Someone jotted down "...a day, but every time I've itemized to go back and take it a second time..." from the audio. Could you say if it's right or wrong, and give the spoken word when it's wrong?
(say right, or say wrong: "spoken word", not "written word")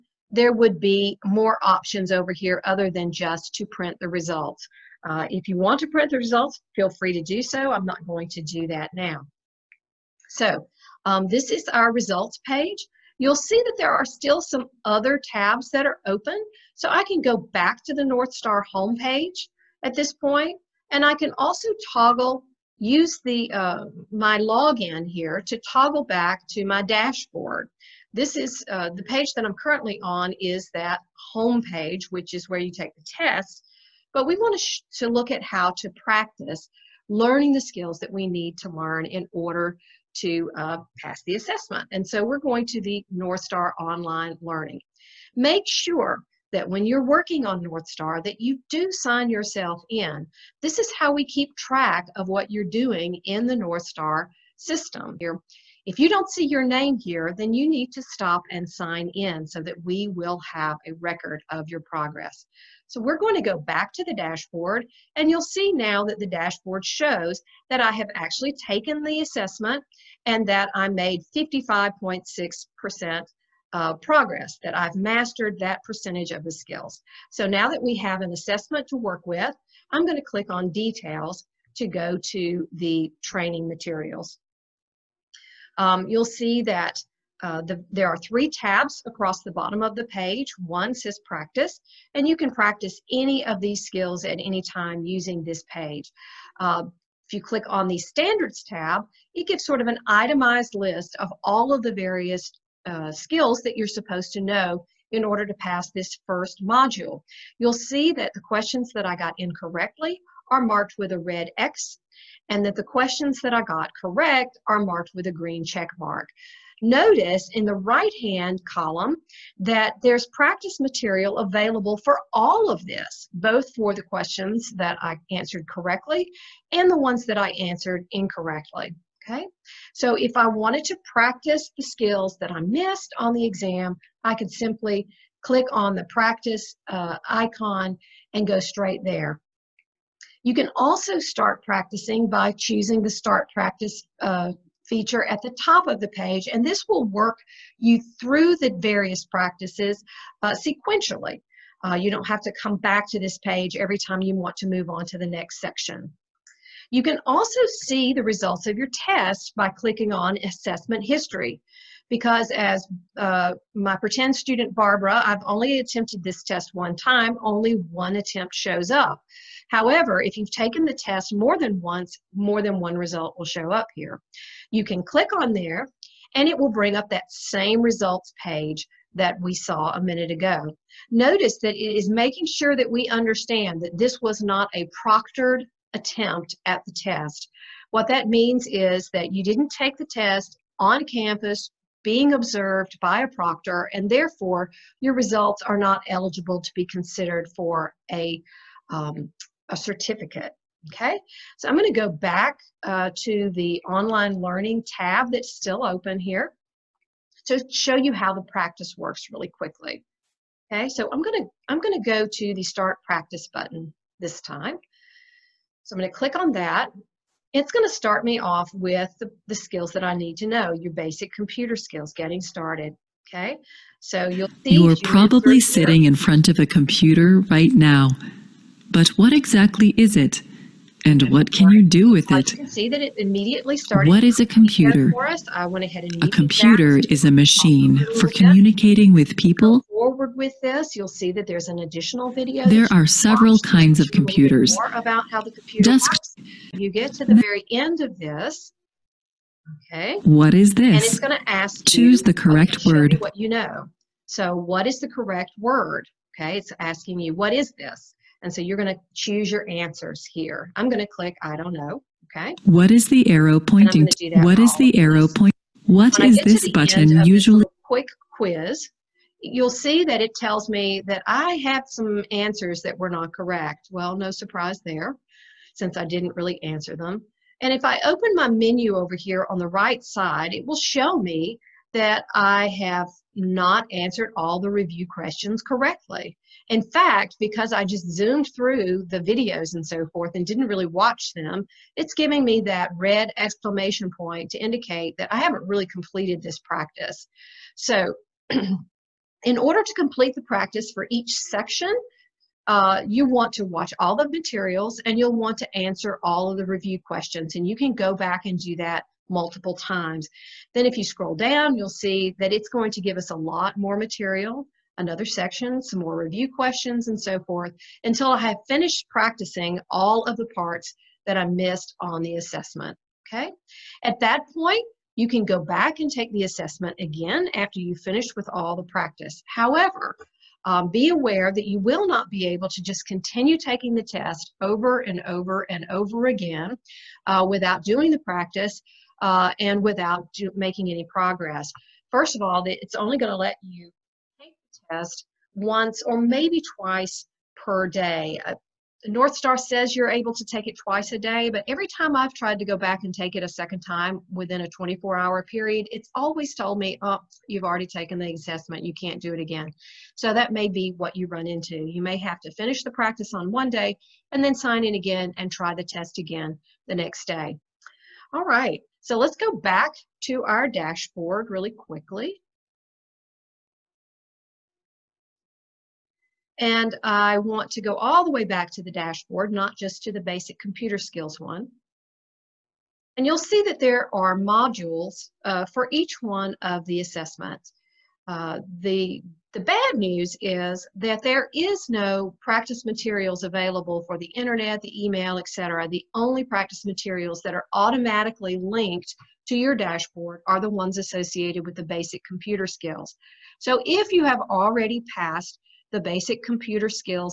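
wrong: "tried", not "itemized".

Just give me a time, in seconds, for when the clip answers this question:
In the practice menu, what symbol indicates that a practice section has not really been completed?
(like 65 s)
292 s.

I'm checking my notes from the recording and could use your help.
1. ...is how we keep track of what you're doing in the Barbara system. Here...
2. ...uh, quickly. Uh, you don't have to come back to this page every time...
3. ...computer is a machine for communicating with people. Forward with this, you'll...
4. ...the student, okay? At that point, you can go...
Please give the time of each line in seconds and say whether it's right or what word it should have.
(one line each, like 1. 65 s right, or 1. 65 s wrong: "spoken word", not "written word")
1. 50 s wrong: "Northstar", not "Barbara"
2. 150 s wrong: "sequentially", not "quickly"
3. 236 s right
4. 322 s wrong: "assessment", not "student".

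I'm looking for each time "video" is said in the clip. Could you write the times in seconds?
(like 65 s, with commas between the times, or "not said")
242 s, 289 s.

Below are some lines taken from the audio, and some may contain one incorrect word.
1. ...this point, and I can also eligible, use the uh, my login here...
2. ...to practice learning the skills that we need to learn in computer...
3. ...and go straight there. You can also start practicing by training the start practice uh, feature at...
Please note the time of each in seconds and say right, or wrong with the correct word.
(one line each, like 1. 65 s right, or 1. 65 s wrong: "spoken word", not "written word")
1. 19 s wrong: "toggle", not "eligible"
2. 35 s wrong: "order", not "computer"
3. 138 s wrong: "choosing", not "training".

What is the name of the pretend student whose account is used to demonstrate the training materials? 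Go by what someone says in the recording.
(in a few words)
Barbara.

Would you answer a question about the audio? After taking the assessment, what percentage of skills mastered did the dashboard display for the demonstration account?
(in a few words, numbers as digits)
55.6%.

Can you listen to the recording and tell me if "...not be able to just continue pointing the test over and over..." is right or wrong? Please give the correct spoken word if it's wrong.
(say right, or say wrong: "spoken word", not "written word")
wrong: "taking", not "pointing".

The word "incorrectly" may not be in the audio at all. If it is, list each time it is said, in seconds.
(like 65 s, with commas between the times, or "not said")
109 s, 128 s.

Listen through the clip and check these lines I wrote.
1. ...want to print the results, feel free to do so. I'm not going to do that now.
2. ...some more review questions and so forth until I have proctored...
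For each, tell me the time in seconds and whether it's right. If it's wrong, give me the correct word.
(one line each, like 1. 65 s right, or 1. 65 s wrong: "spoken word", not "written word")
1. 5 s right
2. 315 s wrong: "finished", not "proctored".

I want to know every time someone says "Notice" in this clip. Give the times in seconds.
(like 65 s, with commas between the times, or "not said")
116 s, 181 s.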